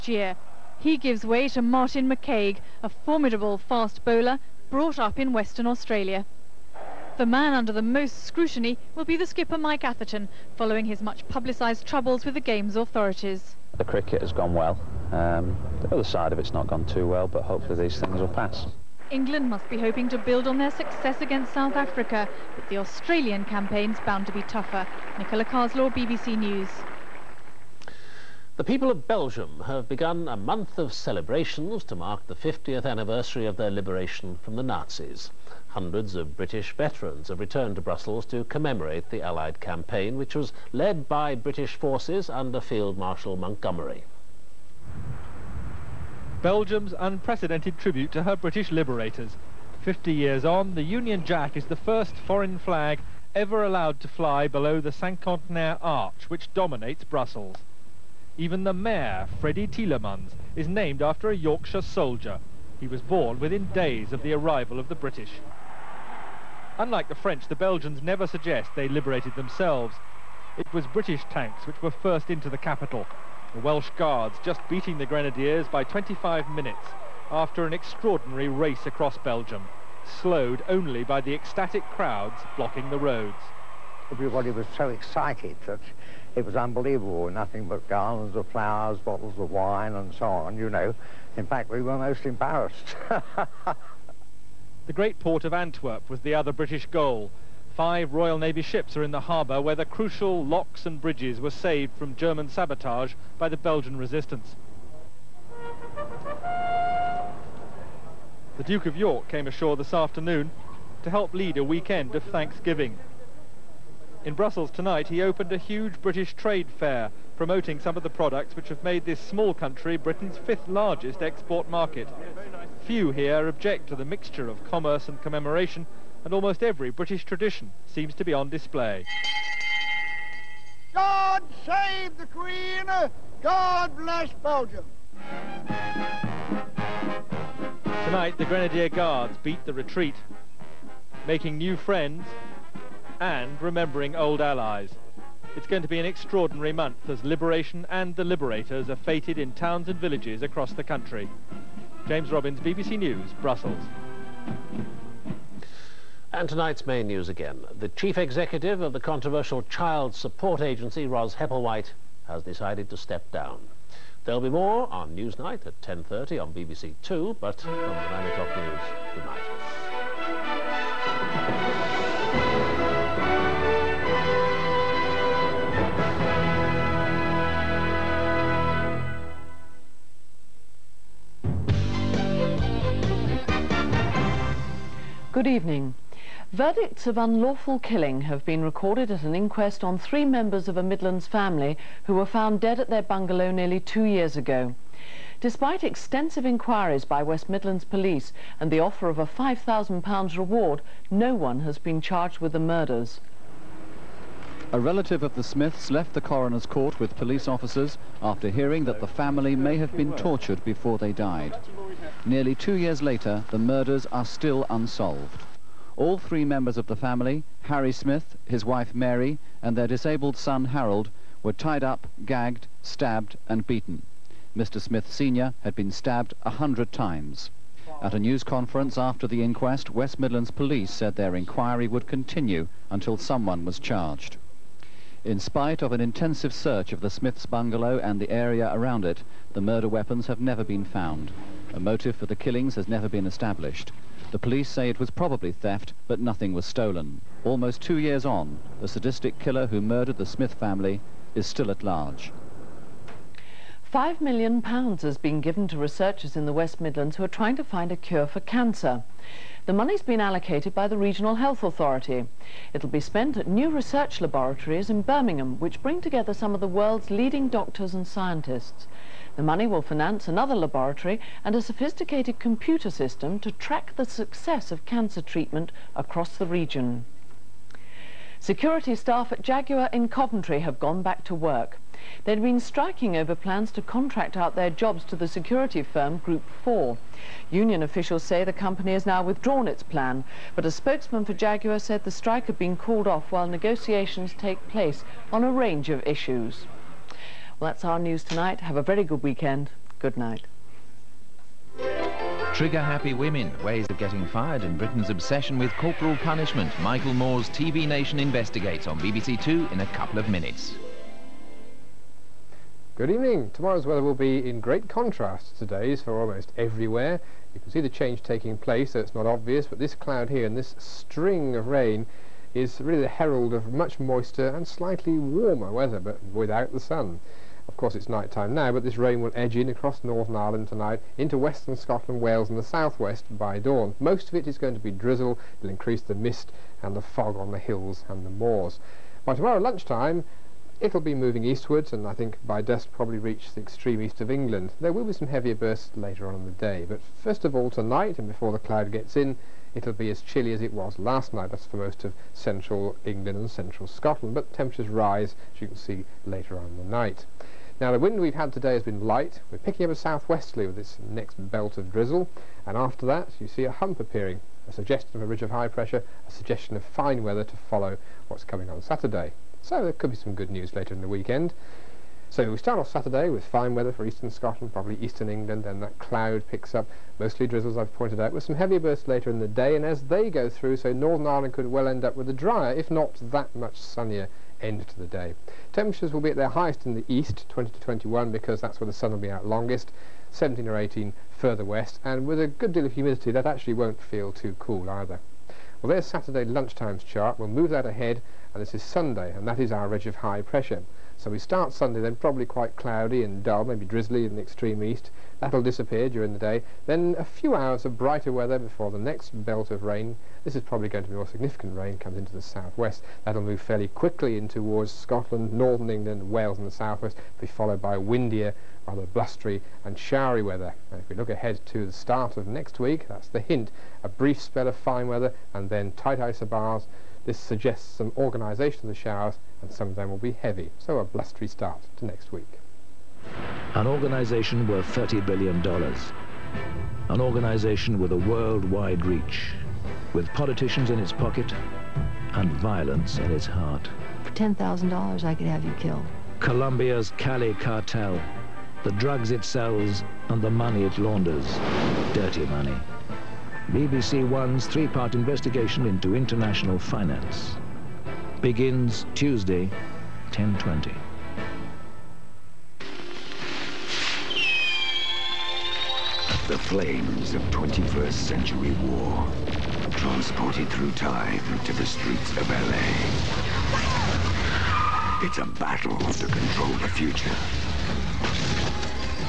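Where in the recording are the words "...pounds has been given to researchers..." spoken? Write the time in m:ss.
4:14.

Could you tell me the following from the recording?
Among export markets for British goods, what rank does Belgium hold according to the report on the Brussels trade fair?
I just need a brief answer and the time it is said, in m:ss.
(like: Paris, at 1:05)
Fifth, at 2:00.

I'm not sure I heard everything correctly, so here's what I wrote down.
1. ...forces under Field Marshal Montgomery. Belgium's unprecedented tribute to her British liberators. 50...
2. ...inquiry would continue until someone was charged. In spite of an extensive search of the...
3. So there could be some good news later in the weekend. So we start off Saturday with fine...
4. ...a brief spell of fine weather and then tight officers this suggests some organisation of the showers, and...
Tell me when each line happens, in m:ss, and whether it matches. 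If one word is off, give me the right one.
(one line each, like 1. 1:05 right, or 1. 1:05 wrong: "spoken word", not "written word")
1. 0:41 right
2. 3:51 wrong: "intensive", not "extensive"
3. 6:09 right
4. 7:04 wrong: "isobars", not "officers".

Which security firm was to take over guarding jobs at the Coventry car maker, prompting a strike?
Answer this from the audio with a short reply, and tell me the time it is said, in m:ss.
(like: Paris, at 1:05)
Group 4, at 4:46.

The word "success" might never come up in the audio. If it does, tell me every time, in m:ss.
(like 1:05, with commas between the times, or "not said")
0:20, 4:34.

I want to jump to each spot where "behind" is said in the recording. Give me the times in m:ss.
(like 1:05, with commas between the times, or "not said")
not said.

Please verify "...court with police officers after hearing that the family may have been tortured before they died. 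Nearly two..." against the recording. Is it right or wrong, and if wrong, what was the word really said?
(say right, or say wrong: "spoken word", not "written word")
right.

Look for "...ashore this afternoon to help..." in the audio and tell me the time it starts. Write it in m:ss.
1:49.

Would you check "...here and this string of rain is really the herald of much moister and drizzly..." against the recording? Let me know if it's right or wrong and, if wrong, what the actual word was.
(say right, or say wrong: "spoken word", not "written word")
wrong: "slightly", not "drizzly".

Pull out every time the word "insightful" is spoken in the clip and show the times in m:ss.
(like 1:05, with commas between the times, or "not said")
not said.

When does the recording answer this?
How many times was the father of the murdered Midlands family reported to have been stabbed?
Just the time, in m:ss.
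3:46.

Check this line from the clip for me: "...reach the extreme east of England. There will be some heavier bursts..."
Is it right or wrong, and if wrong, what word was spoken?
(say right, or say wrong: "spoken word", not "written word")
right.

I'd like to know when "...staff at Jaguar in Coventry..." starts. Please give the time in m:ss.
4:38.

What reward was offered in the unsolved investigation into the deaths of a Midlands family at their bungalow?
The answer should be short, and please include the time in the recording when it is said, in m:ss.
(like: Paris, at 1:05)
£5,000, at 3:19.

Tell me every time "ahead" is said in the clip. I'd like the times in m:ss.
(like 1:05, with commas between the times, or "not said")
6:37, 7:01.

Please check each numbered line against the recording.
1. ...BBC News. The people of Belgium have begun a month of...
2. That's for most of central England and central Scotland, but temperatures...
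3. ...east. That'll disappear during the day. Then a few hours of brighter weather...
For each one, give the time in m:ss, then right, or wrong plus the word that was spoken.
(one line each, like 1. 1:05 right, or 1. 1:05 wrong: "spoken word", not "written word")
1. 0:25 right
2. 5:51 right
3. 6:44 right.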